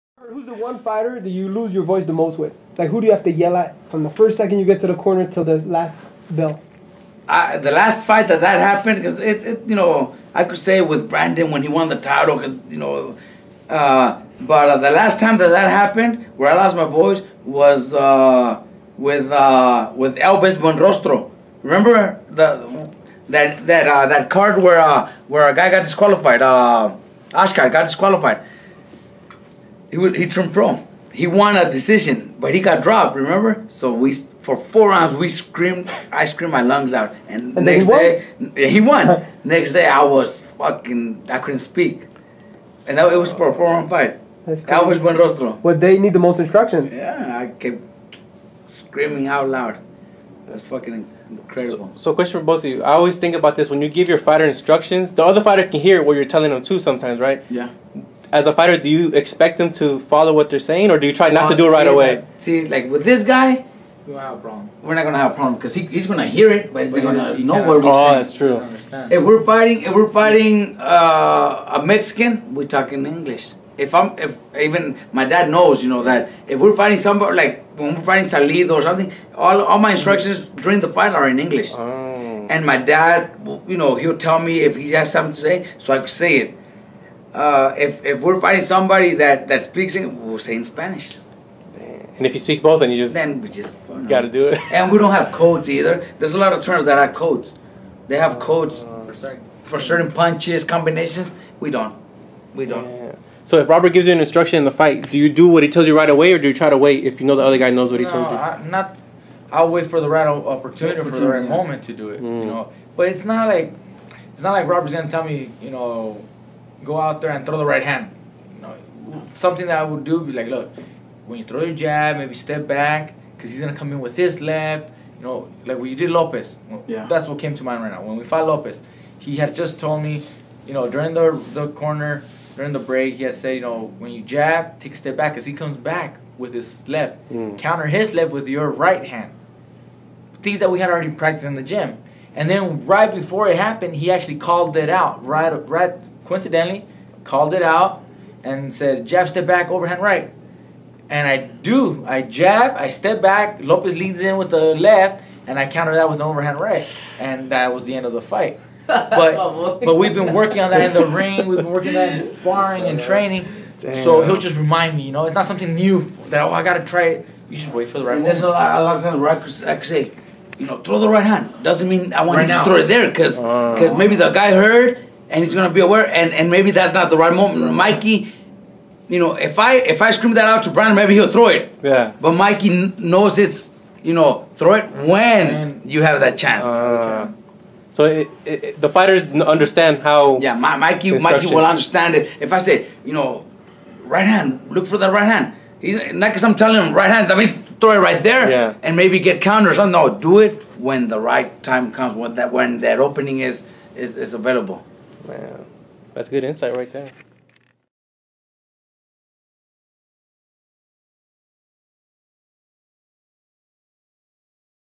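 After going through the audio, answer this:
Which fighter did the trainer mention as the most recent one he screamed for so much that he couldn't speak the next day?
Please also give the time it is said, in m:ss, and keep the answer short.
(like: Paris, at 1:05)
Elvis Buenrostro, at 0:20.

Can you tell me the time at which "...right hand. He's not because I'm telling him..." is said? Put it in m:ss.
3:15.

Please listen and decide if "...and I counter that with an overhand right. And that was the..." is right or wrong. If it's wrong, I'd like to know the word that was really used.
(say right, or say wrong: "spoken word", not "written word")
right.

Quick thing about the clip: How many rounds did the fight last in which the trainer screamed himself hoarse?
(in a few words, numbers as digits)
4.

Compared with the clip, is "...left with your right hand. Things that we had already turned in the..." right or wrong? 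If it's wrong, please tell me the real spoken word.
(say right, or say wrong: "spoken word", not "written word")
wrong: "practiced", not "turned".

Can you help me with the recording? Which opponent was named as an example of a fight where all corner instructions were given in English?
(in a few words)
Salido.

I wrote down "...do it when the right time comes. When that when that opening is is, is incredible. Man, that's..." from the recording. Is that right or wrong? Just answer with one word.
wrong.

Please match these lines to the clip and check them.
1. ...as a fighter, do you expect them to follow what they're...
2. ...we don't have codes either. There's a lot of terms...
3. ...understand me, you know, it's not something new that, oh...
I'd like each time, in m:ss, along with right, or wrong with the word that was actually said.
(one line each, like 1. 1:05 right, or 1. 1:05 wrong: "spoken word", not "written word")
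1. 0:58 right
2. 1:34 right
3. 2:44 wrong: "remind", not "understand".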